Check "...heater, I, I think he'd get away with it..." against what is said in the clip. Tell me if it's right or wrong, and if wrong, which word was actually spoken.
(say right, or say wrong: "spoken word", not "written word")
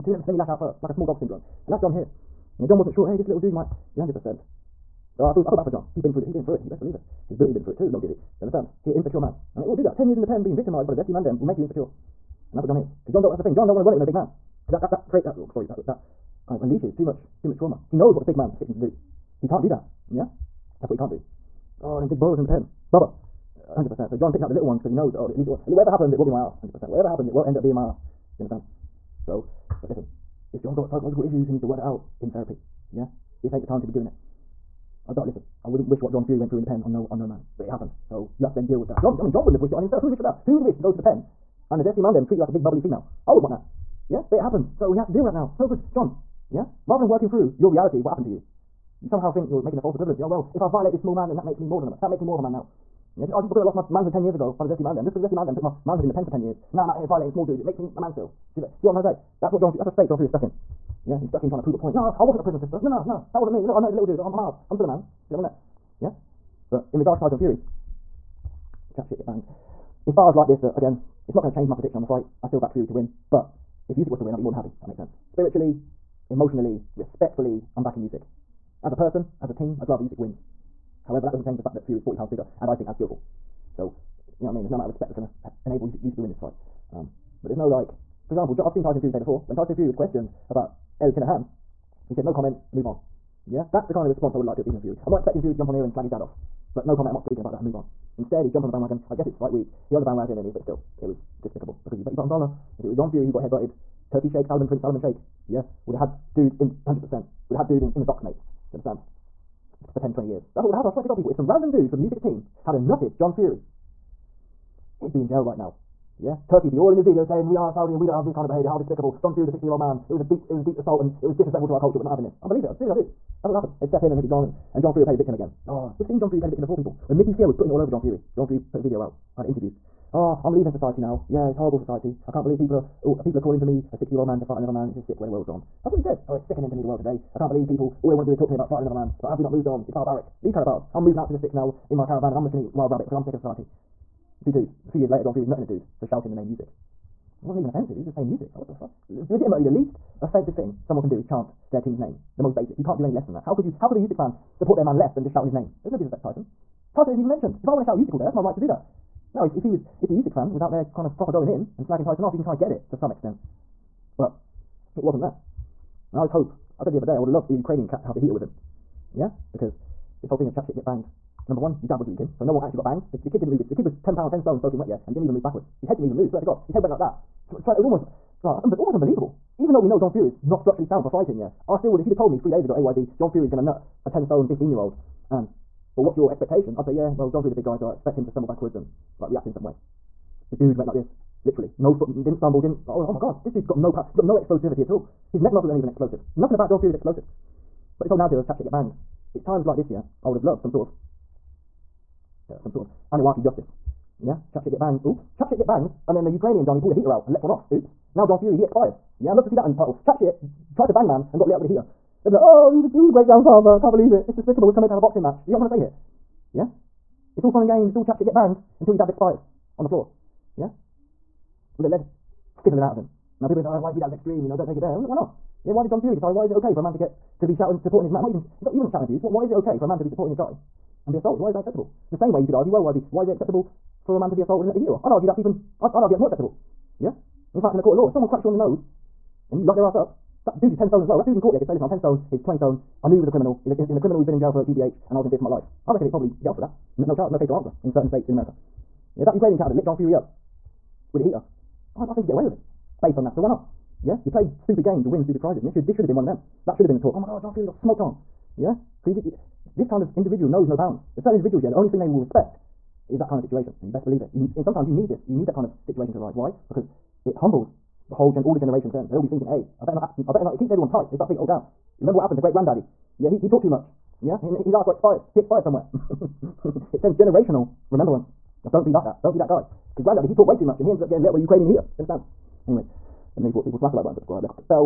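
right.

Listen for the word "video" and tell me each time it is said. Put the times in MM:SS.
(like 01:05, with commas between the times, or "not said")
01:57, 02:08.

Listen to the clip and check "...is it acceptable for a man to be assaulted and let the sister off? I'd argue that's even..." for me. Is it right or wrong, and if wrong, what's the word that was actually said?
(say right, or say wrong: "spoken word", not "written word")
wrong: "heater", not "sister".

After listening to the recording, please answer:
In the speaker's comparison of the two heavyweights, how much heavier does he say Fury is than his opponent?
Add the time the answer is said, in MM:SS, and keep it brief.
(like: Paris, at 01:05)
40 pounds, at 01:22.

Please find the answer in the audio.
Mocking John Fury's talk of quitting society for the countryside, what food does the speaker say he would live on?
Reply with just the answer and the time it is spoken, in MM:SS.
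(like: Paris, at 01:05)
Wild rabbit, at 02:22.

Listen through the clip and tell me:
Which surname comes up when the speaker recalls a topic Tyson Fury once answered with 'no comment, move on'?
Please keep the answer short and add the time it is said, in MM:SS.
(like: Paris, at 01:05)
Kinahan, at 01:31.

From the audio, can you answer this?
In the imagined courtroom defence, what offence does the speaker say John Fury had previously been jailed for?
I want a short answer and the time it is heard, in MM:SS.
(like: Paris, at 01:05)
GBH, at 04:04.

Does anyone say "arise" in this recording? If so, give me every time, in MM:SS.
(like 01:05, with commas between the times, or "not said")
04:26.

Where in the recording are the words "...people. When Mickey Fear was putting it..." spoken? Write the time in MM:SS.
02:06.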